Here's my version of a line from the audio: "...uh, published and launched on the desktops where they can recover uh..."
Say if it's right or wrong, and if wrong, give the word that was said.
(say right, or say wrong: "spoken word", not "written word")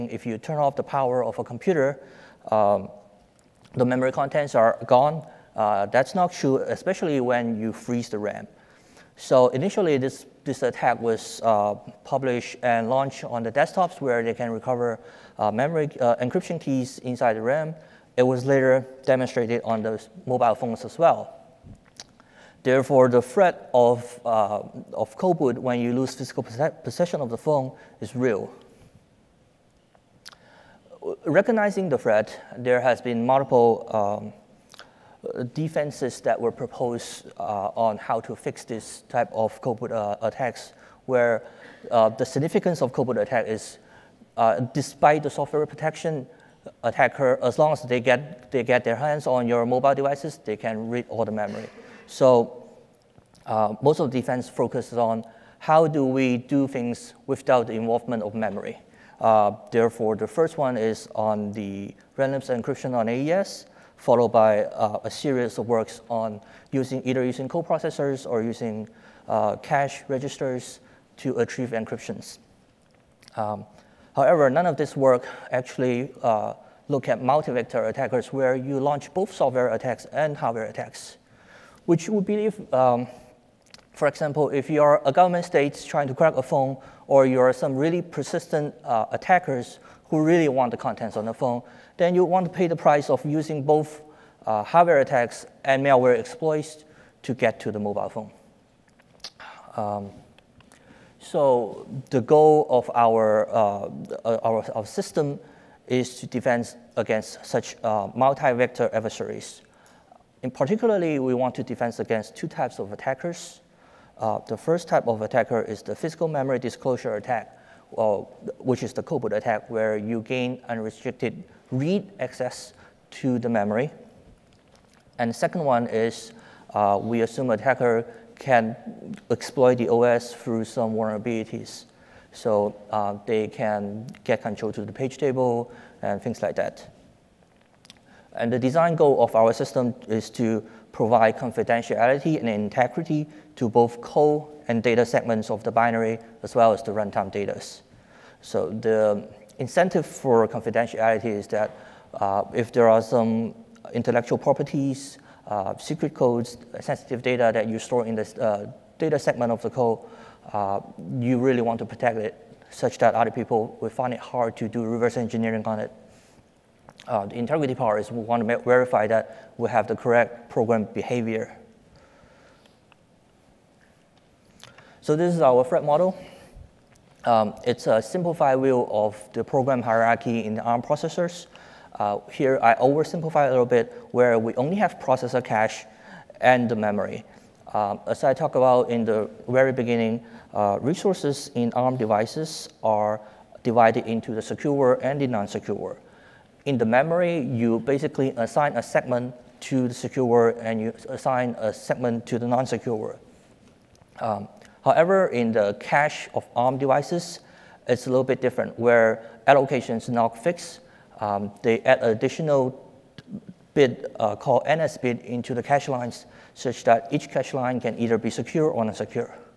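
right.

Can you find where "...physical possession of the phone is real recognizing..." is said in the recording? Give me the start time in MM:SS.
00:26.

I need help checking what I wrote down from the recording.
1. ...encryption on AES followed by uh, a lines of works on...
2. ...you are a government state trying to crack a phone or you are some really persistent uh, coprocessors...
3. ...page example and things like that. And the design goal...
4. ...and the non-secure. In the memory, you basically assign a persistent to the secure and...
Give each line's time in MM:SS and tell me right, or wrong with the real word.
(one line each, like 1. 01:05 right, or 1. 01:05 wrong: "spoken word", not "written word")
1. 01:02 wrong: "series", not "lines"
2. 01:24 wrong: "attackers", not "coprocessors"
3. 02:14 wrong: "table", not "example"
4. 03:15 wrong: "segment", not "persistent".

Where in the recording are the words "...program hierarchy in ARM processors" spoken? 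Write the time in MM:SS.
02:59.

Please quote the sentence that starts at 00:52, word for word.
So uh, most of defense focuses on how do we do things without the involvement of memory.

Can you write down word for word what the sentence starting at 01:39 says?
Um, so the goal of our, uh, uh our, our, system is to defend against such uh, multi-vector adversaries.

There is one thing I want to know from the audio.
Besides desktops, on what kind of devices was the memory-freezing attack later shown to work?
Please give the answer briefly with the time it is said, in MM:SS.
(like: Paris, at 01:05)
mobile phones, at 00:20.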